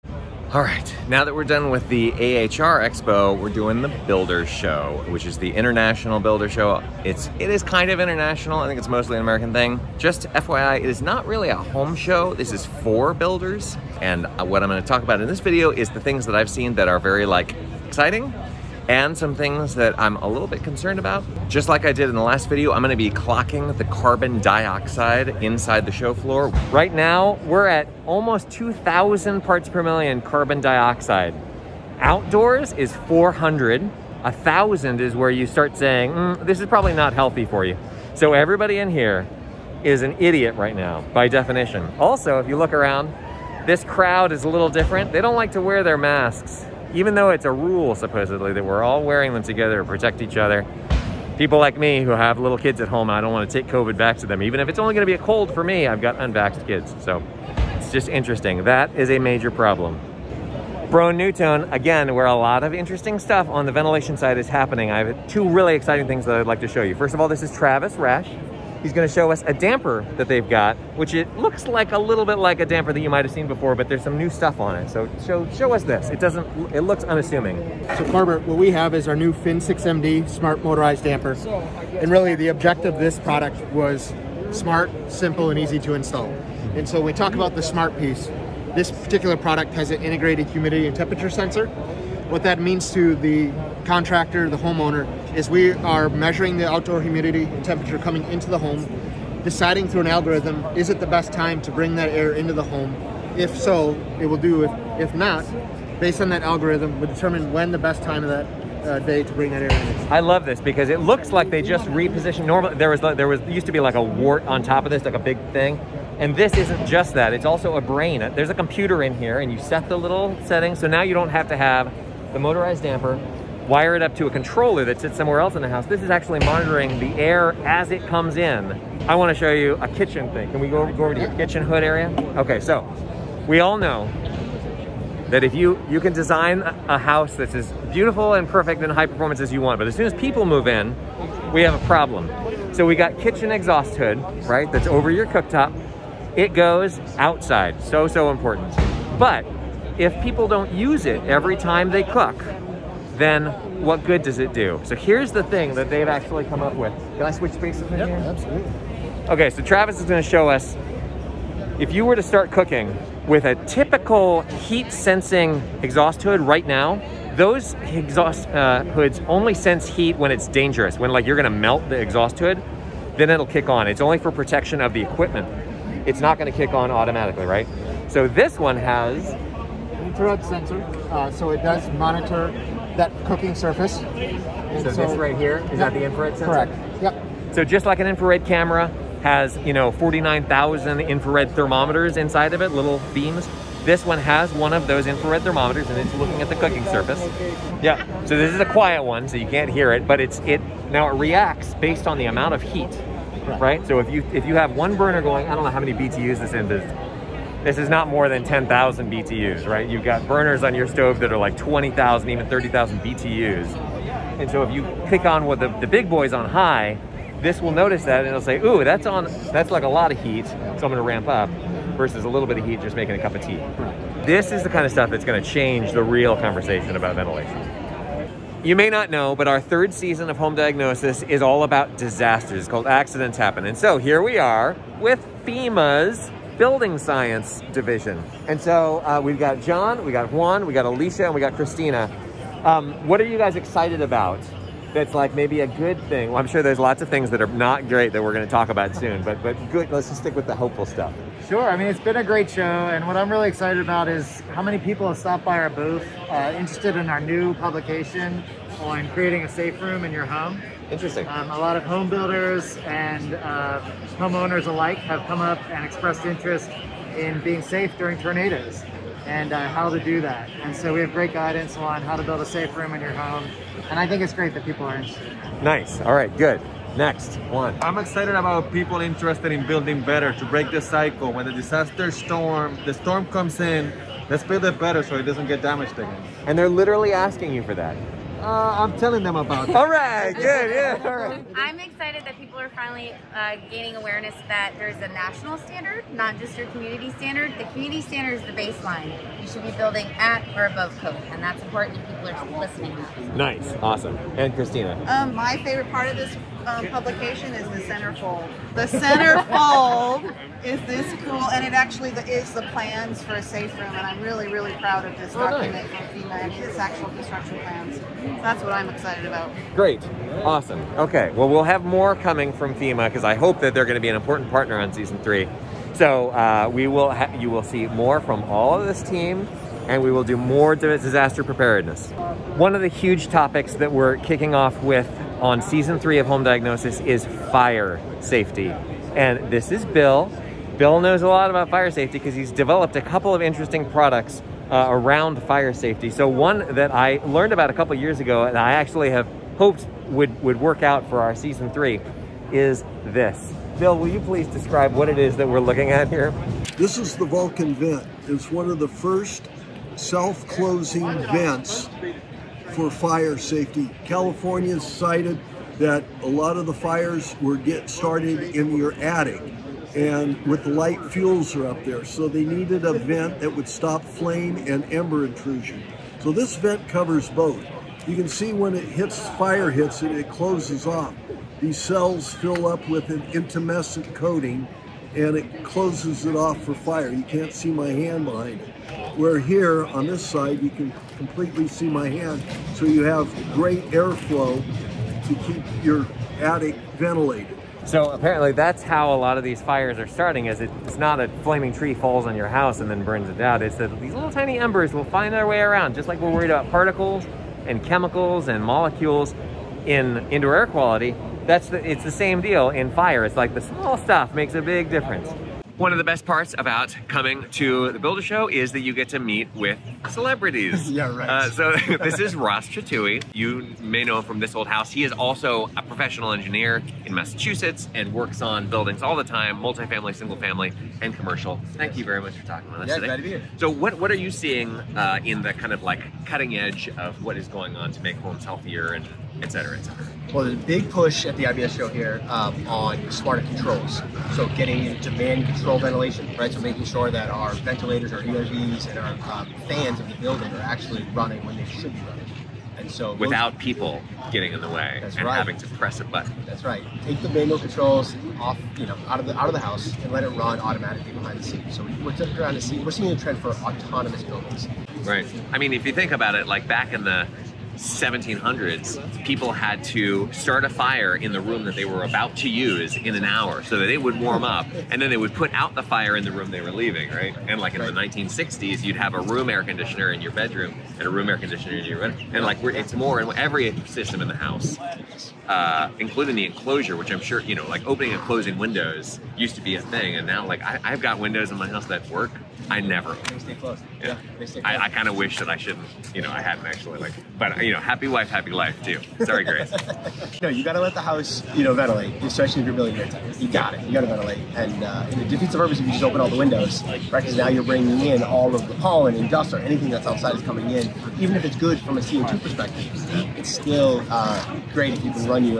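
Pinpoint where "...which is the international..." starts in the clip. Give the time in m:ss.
0:05.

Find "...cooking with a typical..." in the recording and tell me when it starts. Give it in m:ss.
2:42.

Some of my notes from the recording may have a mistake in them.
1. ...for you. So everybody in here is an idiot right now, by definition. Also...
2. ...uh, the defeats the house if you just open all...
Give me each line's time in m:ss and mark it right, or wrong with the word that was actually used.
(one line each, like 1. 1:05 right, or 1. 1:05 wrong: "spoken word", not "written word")
1. 0:37 right
2. 8:24 wrong: "purpose", not "house".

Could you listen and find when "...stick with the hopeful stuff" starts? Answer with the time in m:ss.
4:10.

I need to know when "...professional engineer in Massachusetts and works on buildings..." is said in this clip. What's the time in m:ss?
7:05.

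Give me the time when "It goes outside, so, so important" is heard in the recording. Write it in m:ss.
2:26.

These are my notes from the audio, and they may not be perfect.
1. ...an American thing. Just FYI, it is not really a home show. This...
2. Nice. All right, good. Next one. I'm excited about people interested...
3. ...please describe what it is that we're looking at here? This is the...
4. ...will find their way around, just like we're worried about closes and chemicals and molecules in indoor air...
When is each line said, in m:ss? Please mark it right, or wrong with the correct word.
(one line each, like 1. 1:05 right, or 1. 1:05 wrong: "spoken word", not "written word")
1. 0:09 right
2. 4:35 right
3. 5:54 right
4. 6:44 wrong: "particles", not "closes".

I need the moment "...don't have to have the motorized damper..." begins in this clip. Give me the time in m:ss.
2:01.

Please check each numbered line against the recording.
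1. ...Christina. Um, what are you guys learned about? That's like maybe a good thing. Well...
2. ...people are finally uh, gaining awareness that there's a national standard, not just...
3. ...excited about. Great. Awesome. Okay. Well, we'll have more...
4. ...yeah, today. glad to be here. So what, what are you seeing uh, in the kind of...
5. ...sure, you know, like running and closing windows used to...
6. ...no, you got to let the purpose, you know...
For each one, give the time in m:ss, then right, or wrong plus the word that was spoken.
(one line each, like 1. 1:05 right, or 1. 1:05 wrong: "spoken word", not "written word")
1. 4:01 wrong: "excited", not "learned"
2. 4:52 right
3. 5:18 right
4. 7:12 right
5. 8:07 wrong: "opening", not "running"
6. 8:20 wrong: "house", not "purpose".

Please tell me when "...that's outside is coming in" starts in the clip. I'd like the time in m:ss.
8:29.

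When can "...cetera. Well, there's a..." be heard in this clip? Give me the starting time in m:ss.
7:19.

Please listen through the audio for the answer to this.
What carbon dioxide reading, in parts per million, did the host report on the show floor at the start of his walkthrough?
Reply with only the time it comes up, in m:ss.
0:28.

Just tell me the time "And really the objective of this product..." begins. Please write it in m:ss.
1:22.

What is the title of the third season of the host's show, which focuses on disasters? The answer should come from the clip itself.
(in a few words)
Accidents Happen.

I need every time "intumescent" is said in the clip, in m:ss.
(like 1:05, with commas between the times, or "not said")
6:23.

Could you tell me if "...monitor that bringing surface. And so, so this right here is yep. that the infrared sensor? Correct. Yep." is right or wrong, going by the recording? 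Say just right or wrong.
wrong.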